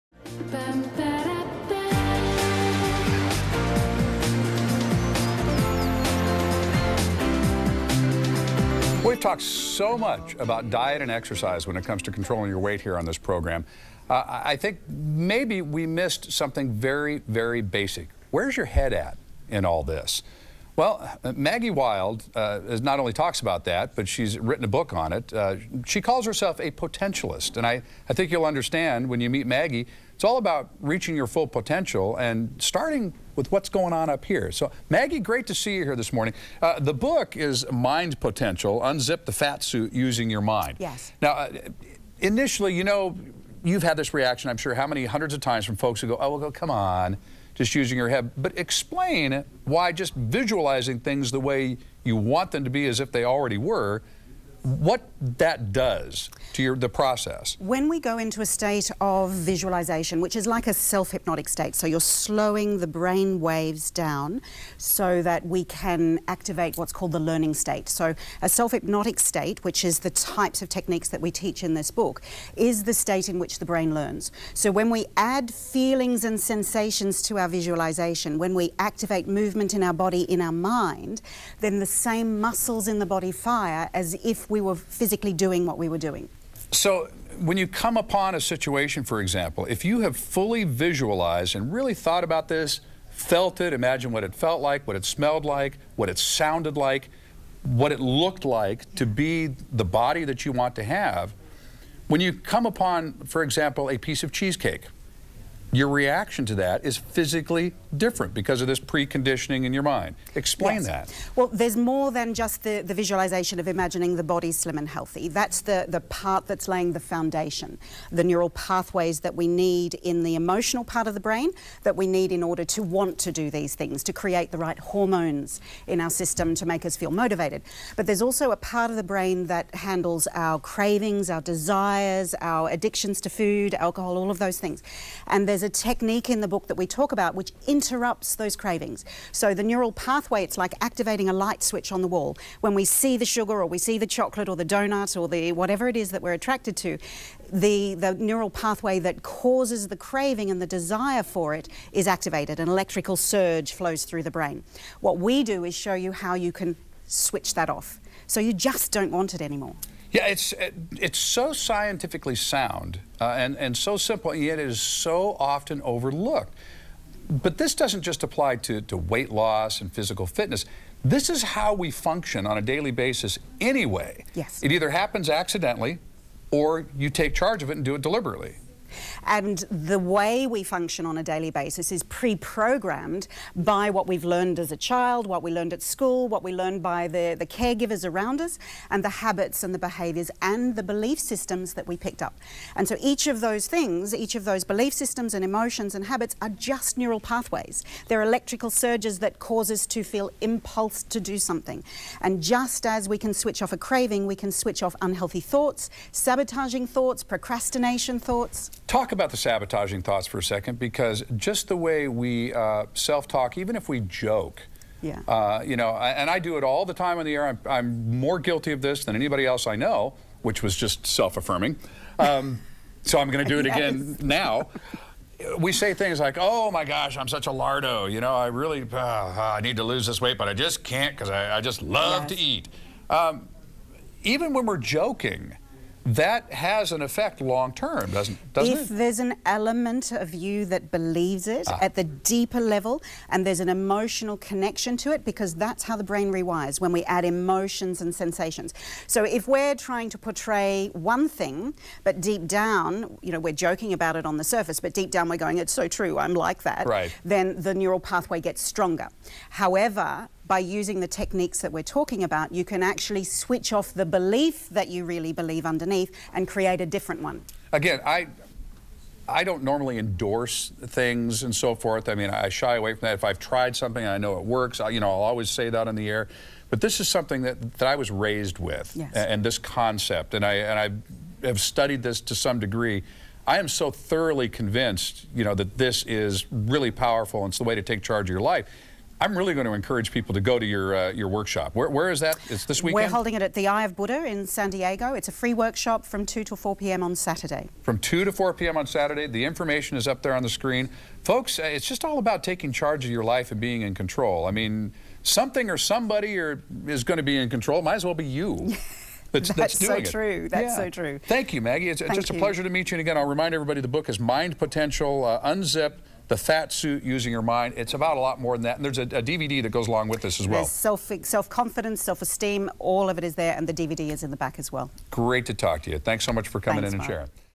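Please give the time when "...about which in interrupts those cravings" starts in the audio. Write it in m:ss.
2:17.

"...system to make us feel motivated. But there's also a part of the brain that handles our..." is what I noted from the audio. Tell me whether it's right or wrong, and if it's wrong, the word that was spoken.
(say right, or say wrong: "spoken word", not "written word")
right.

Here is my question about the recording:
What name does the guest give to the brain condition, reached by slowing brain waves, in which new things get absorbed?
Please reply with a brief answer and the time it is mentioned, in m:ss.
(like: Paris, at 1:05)
The learning state, at 1:07.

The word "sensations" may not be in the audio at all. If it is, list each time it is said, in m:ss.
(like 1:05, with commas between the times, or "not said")
1:16, 4:08.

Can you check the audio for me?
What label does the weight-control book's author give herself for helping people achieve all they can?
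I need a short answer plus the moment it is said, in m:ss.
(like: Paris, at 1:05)
A potentialist, at 0:26.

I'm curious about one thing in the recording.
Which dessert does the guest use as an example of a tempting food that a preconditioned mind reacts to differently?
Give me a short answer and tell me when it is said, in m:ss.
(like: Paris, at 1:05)
Cheesecake, at 1:44.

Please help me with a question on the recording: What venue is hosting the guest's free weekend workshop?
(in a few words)
The Eye of Buddha.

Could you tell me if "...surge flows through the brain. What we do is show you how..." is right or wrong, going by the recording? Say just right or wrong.
right.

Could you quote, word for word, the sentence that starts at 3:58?
If there's an element of you that believes it ah.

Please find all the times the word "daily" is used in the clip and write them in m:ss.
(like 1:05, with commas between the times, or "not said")
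2:52, 3:01.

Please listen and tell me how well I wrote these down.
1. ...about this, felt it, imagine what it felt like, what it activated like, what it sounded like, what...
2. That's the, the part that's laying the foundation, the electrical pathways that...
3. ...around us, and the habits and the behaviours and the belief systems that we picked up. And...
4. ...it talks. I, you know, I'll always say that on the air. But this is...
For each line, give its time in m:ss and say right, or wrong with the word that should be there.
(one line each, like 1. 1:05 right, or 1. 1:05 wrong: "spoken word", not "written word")
1. 1:32 wrong: "smelled", not "activated"
2. 1:55 wrong: "neural", not "electrical"
3. 3:08 right
4. 4:34 wrong: "works", not "talks".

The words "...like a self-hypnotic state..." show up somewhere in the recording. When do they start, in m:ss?
1:00.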